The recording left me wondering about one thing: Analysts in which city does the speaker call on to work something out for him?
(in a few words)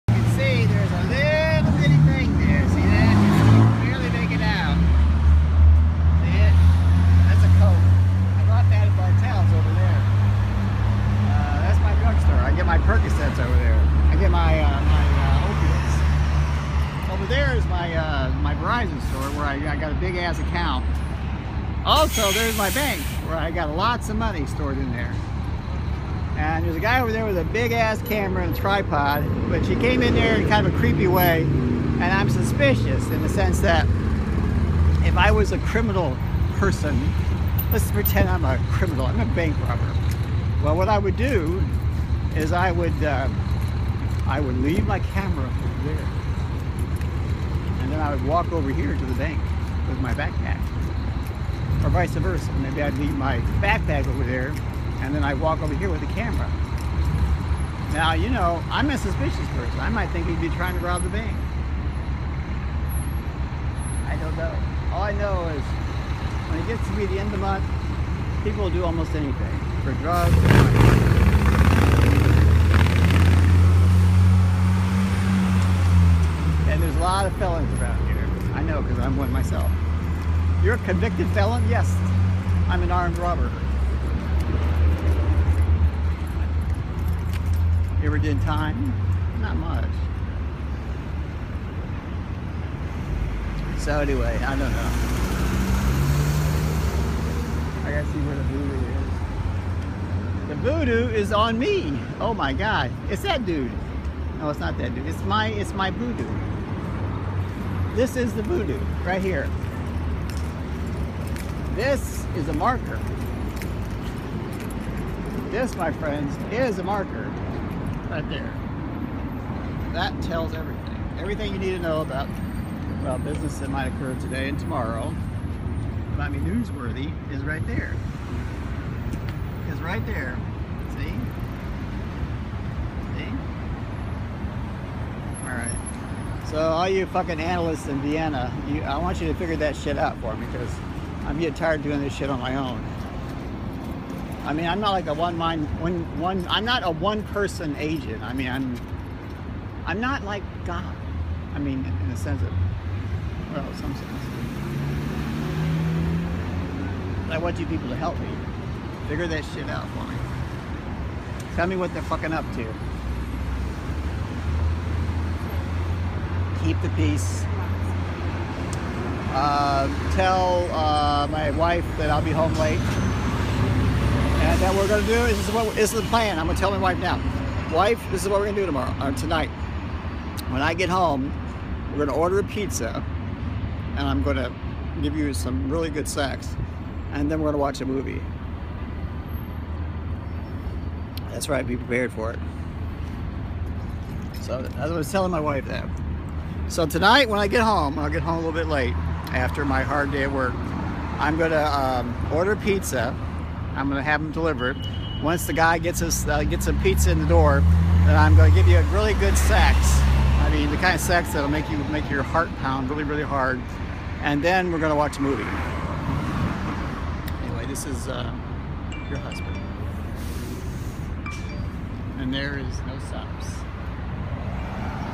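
Vienna.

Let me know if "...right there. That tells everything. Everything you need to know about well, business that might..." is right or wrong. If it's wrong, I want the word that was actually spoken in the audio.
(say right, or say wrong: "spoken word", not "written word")
right.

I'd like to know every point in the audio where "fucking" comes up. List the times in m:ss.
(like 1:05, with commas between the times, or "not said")
2:17, 2:42.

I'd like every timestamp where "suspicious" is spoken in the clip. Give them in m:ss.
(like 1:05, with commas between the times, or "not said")
0:32, 0:58.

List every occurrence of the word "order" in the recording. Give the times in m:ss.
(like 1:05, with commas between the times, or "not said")
3:02, 3:22.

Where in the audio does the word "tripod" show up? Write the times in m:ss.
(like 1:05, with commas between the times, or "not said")
0:28.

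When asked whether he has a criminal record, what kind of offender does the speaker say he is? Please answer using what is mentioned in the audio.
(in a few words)
Armed robber.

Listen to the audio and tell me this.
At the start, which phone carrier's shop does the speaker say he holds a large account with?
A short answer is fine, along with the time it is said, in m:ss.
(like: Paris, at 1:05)
Verizon, at 0:18.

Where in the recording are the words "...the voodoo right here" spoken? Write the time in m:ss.
1:48.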